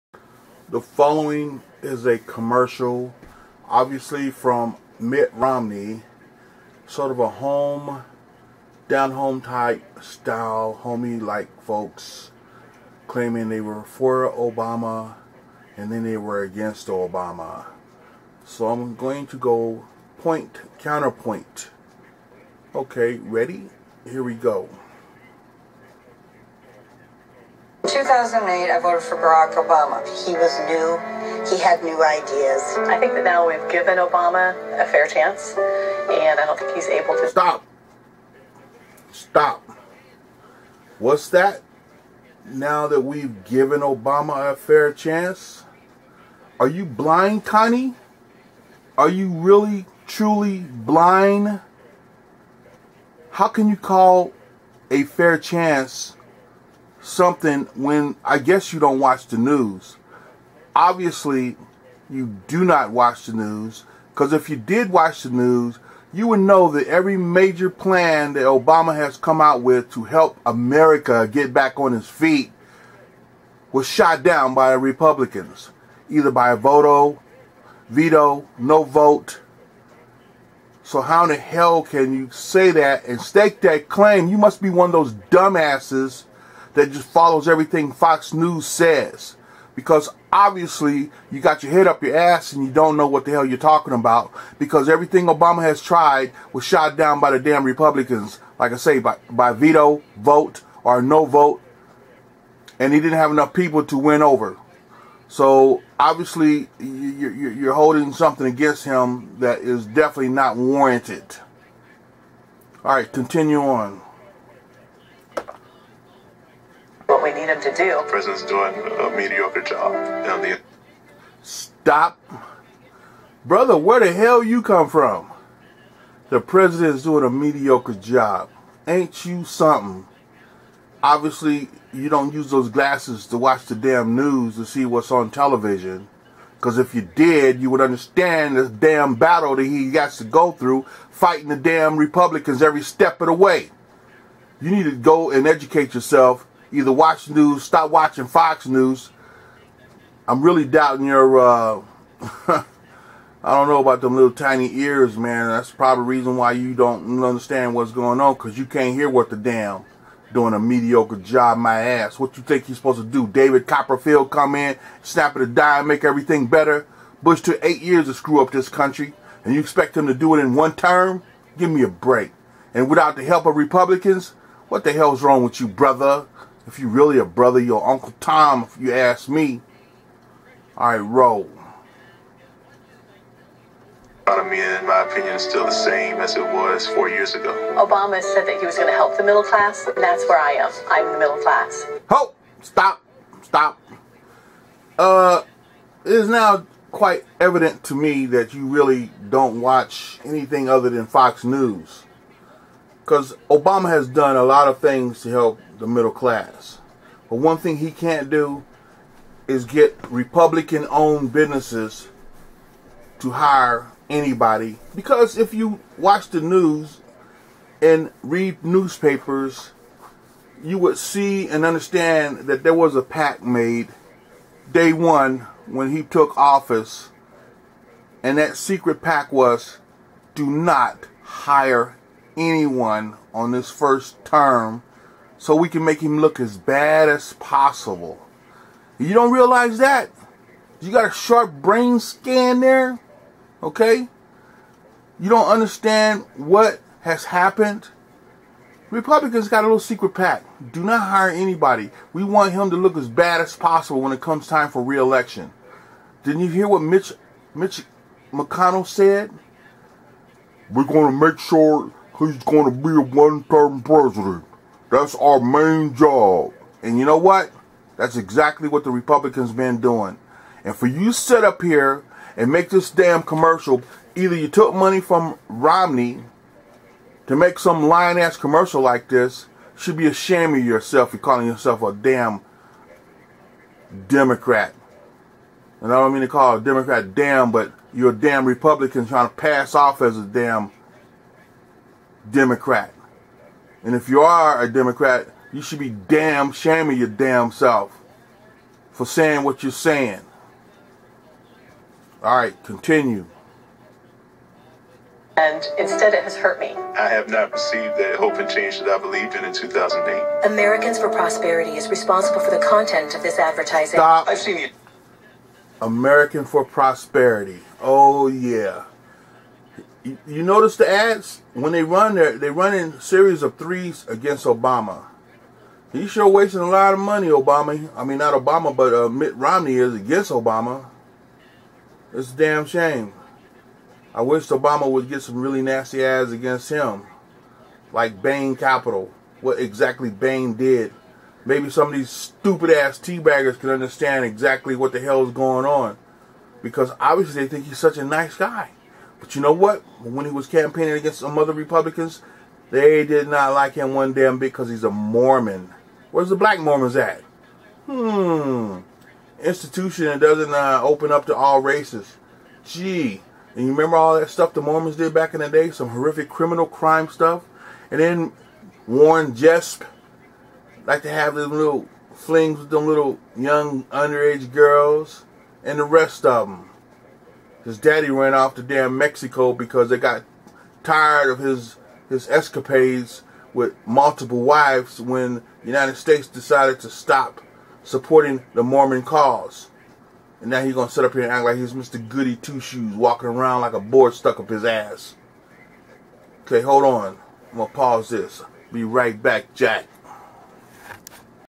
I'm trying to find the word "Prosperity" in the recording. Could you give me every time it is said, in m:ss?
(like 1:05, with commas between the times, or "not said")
5:11, 5:16.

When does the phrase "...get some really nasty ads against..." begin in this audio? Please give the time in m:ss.
5:35.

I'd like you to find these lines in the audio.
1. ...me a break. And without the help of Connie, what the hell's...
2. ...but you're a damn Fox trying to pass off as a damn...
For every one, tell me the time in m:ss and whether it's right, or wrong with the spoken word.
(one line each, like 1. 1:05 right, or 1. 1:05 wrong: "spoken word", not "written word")
1. 2:51 wrong: "Republicans", not "Connie"
2. 4:47 wrong: "Republican", not "Fox".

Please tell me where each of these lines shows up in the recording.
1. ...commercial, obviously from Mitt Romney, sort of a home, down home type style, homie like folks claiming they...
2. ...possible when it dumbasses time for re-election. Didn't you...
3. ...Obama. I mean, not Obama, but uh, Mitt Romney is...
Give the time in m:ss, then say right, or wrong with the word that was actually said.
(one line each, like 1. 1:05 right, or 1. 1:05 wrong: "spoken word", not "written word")
1. 0:02 right
2. 4:13 wrong: "comes", not "dumbasses"
3. 5:27 right.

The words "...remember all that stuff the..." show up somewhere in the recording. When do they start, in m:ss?
6:03.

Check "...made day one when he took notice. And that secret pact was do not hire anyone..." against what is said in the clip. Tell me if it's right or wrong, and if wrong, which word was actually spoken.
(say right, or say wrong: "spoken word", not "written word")
wrong: "office", not "notice".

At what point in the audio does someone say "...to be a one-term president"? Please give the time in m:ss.
4:22.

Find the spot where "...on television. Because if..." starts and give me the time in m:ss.
2:15.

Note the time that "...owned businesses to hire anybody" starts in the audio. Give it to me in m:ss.
3:30.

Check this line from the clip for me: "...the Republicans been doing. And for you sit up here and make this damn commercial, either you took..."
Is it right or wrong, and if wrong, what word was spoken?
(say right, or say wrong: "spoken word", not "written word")
right.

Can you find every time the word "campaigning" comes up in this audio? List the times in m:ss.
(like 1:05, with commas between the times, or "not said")
5:50.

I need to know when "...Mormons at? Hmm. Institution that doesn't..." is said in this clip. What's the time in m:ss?
5:56.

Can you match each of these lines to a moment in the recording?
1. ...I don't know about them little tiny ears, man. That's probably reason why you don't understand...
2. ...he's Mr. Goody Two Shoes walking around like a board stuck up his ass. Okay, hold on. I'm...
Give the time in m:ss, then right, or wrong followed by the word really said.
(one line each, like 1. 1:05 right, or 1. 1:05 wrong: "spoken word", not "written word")
1. 2:33 right
2. 6:31 right.